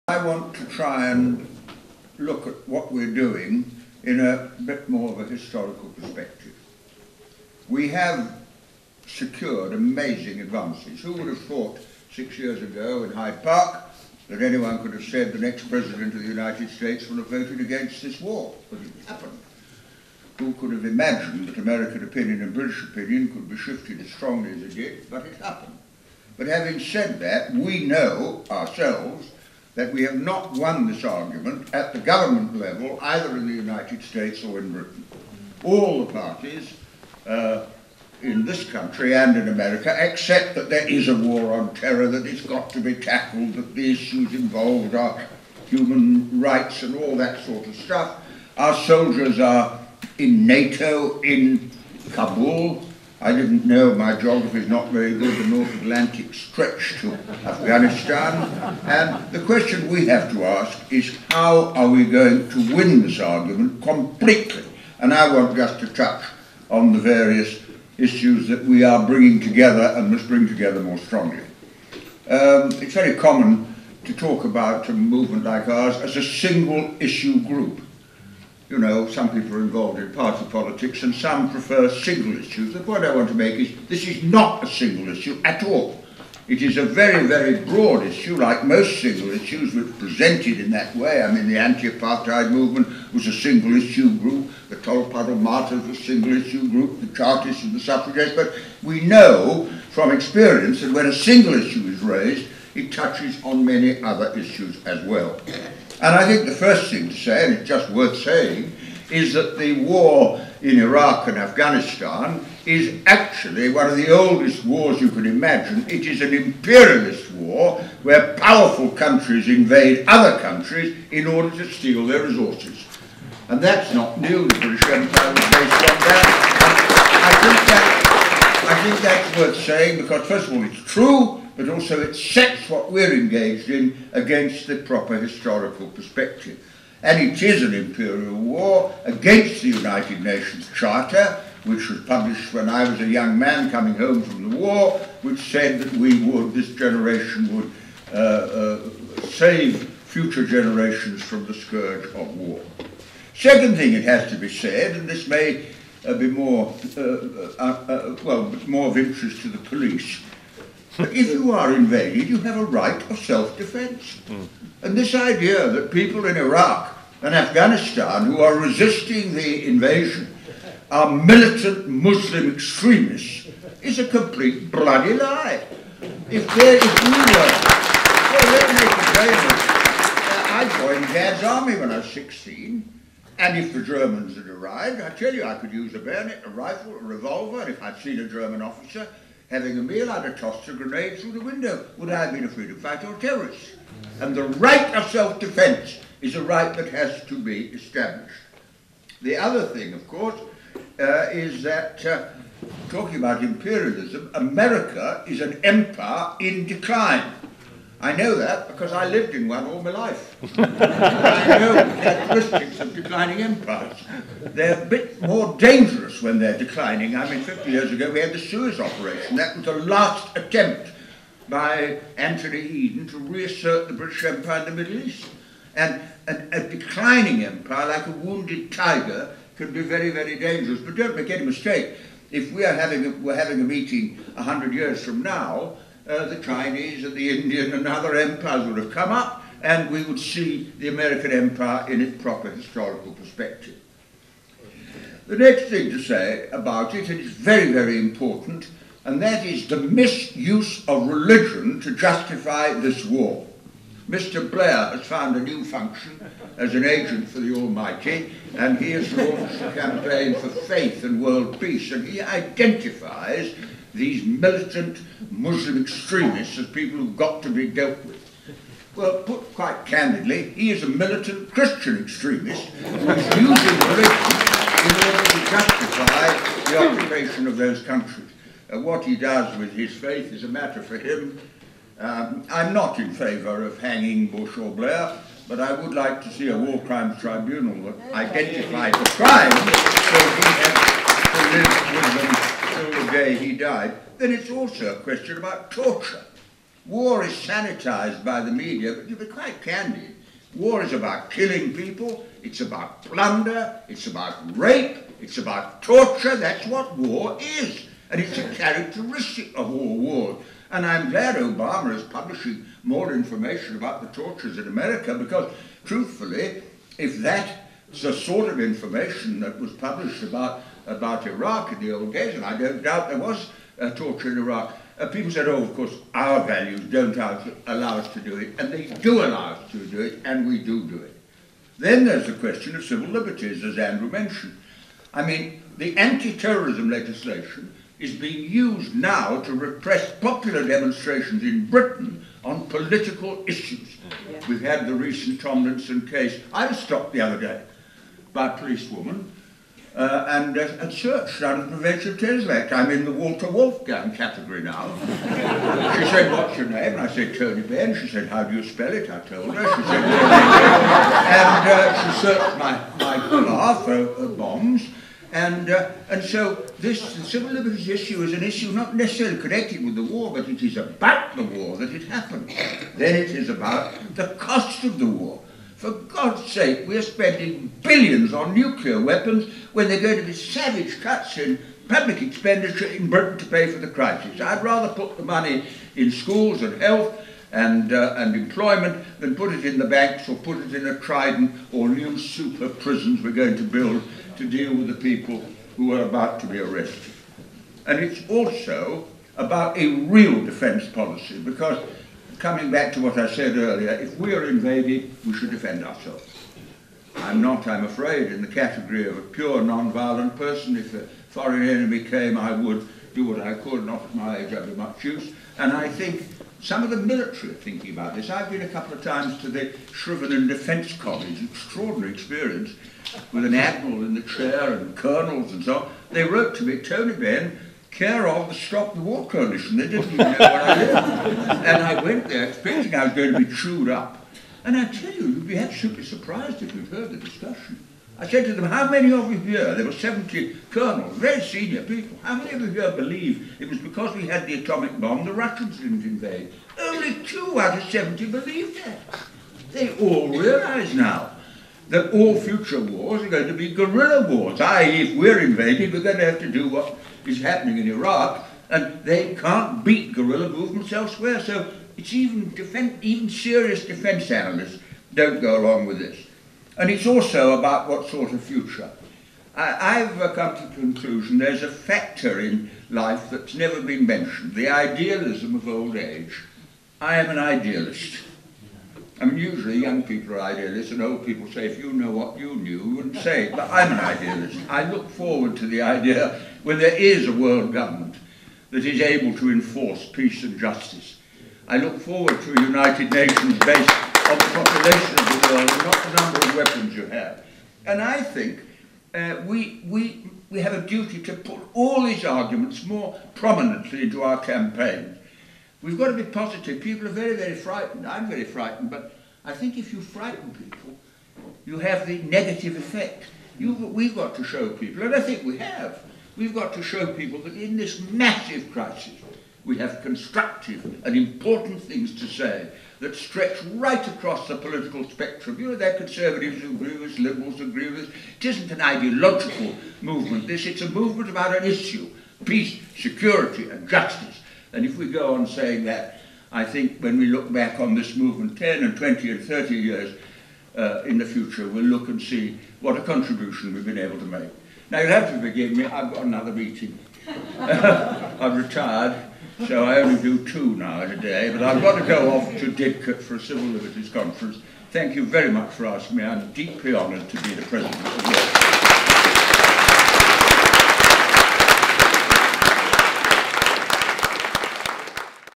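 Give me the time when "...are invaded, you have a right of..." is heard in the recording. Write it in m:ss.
2:41.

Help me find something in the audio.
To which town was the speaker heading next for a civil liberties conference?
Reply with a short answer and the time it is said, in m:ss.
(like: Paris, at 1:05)
Didcot, at 9:12.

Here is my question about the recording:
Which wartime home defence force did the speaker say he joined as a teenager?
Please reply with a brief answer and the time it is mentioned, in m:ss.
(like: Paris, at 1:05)
Dad's Army, at 3:01.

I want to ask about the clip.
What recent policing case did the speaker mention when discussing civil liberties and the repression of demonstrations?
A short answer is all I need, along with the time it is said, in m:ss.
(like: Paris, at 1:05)
Tomlinson case, at 5:45.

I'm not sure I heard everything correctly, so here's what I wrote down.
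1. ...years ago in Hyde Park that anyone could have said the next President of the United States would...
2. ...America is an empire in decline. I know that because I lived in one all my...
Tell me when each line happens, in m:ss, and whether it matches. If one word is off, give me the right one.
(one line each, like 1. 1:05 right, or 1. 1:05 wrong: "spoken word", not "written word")
1. 0:12 right
2. 3:24 right.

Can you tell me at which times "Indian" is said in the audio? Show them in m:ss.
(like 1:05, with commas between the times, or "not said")
3:57.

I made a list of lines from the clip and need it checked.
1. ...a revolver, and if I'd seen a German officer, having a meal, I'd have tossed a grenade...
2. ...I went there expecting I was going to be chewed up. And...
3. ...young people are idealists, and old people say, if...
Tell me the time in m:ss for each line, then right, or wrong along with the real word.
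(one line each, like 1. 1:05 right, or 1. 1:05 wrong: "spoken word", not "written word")
1. 3:06 right
2. 7:11 right
3. 7:59 right.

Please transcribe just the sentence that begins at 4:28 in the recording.
Well, put quite candidly, he is a militant Christian extremist who's using religion in order to justify the occupation of those countries.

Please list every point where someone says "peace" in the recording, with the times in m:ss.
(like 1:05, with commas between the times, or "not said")
4:21, 8:10, 8:52.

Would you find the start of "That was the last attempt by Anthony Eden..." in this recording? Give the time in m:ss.
3:39.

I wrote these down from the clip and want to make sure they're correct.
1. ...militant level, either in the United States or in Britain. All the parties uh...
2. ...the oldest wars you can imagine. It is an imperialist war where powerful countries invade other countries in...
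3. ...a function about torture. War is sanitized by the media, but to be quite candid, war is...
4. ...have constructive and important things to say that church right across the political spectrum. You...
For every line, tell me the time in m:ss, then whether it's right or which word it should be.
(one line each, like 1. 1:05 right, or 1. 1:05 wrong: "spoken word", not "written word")
1. 0:31 wrong: "government", not "militant"
2. 1:53 right
3. 4:54 wrong: "question", not "function"
4. 8:39 wrong: "stretch", not "church".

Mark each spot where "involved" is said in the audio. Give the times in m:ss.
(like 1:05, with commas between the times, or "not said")
0:44, 1:19.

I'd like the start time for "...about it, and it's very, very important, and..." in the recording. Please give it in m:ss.
4:06.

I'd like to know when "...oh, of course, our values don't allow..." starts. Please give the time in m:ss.
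5:25.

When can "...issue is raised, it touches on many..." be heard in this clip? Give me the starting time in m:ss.
1:41.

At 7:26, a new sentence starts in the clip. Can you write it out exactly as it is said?
Only two out of 70 believed that.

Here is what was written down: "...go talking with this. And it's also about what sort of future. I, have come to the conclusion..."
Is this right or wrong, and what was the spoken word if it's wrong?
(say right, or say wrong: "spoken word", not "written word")
wrong: "along", not "talking".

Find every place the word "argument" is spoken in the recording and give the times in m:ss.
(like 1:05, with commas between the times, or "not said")
0:31, 1:03, 8:22.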